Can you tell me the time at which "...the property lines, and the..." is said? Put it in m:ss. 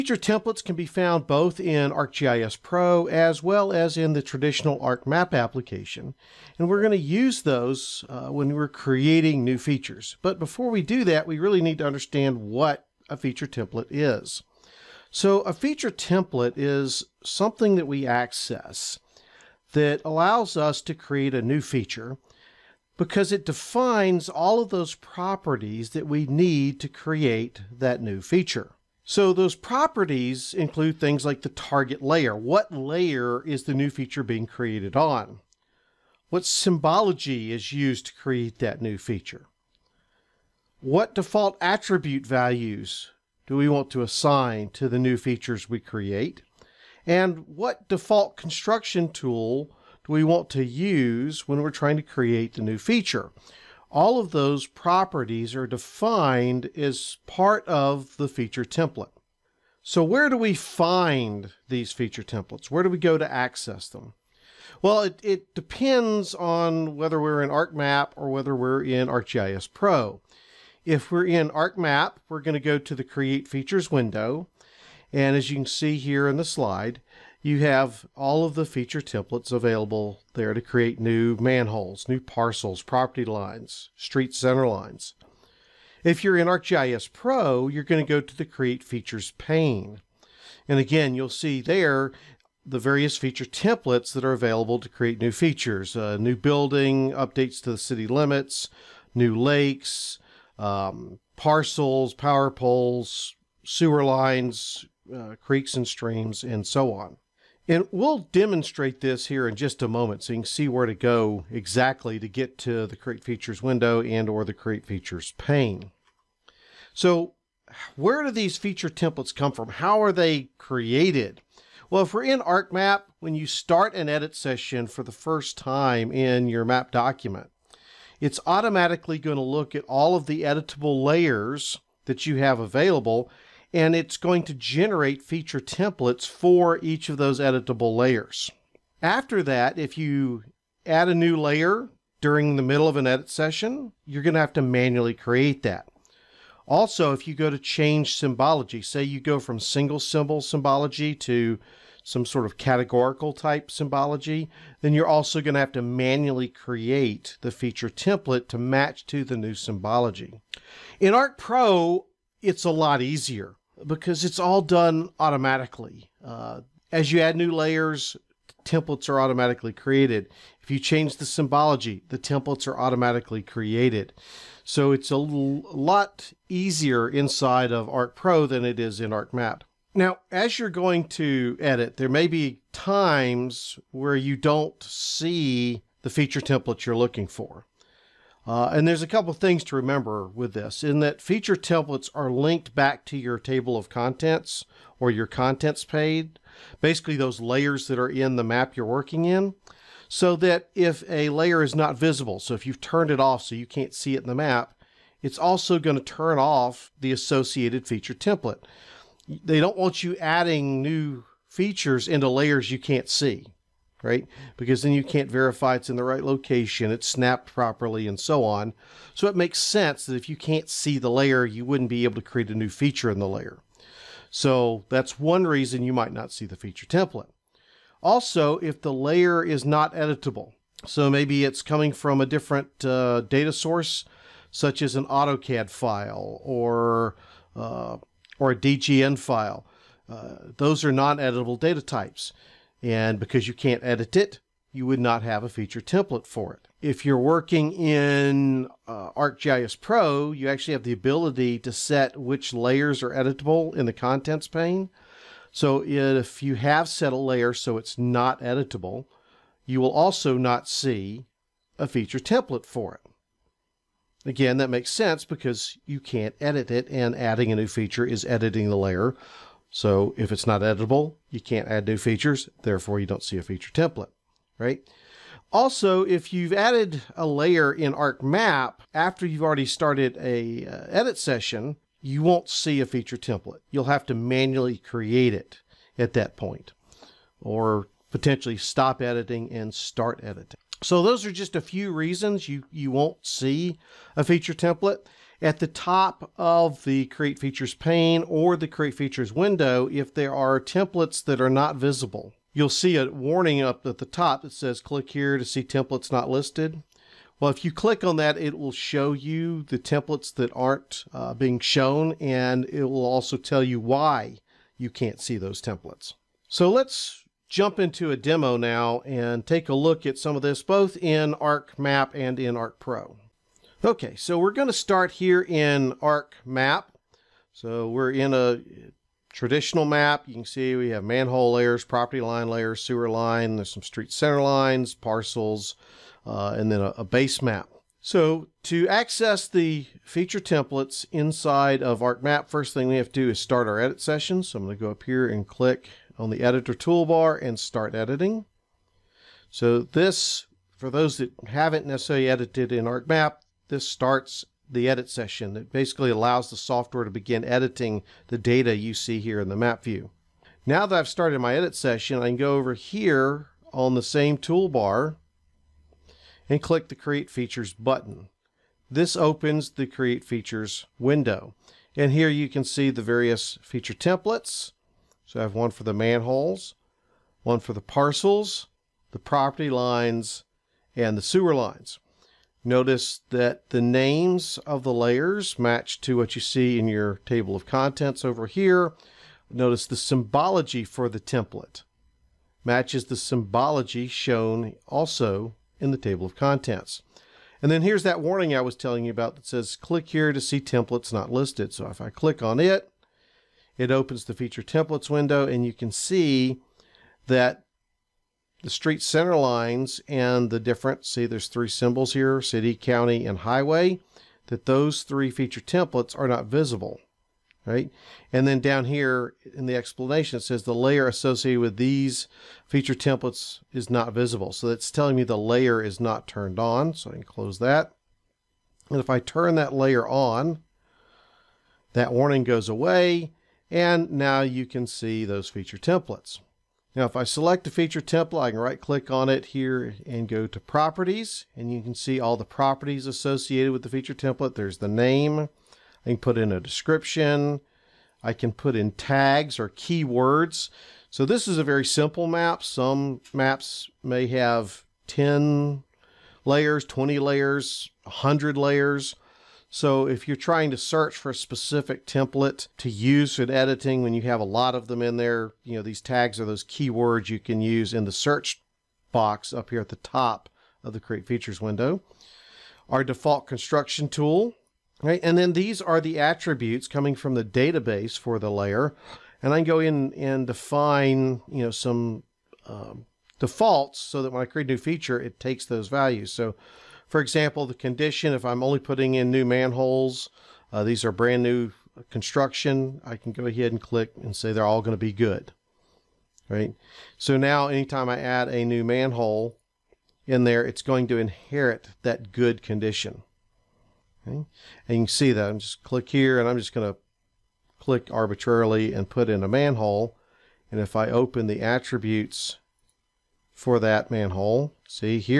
6:19.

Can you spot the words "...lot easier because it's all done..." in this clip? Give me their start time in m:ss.
2:42.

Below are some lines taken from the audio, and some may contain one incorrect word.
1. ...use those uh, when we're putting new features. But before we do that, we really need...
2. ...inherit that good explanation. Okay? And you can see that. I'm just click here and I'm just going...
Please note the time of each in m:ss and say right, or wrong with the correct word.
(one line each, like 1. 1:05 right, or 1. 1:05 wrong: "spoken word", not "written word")
1. 0:06 wrong: "creating", not "putting"
2. 8:21 wrong: "condition", not "explanation".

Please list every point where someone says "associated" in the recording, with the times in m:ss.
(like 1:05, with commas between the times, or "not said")
3:27, 7:01, 7:23.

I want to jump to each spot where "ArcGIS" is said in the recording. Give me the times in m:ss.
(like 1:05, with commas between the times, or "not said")
0:01, 1:09, 1:26, 4:09.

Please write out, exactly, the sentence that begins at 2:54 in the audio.
So it's a lot easier inside of Arc Pro than it is in ArcMap.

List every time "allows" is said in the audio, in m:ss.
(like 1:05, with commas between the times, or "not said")
0:20, 5:56.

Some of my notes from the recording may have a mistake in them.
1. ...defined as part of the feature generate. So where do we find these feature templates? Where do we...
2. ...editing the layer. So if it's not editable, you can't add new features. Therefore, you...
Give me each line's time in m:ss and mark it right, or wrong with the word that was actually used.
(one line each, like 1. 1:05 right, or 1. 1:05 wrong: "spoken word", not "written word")
1. 0:55 wrong: "template", not "generate"
2. 4:28 right.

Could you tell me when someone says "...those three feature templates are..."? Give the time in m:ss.
6:54.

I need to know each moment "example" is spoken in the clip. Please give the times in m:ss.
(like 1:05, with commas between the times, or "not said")
8:07.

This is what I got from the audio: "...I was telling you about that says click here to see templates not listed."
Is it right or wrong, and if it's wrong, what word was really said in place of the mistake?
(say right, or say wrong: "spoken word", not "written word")
right.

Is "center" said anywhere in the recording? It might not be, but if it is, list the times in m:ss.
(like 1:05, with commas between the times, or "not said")
1:24, 5:34, 6:48.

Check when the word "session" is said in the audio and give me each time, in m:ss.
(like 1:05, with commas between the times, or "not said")
2:04, 2:23, 4:41, 5:43, 5:55, 6:01.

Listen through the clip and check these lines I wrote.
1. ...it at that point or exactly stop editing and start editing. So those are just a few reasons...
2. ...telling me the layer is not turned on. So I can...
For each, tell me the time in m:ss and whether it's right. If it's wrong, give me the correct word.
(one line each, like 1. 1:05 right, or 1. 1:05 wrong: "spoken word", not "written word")
1. 4:45 wrong: "potentially", not "exactly"
2. 7:04 right.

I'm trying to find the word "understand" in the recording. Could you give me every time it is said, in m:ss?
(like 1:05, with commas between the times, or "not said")
0:11.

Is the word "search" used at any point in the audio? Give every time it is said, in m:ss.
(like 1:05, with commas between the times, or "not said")
7:40, 7:48.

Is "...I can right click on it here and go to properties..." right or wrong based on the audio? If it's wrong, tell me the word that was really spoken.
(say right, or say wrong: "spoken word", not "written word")
right.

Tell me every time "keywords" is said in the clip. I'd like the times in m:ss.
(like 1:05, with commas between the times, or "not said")
7:29, 7:46.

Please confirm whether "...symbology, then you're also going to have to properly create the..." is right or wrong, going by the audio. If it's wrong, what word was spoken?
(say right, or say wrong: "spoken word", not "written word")
wrong: "manually", not "properly".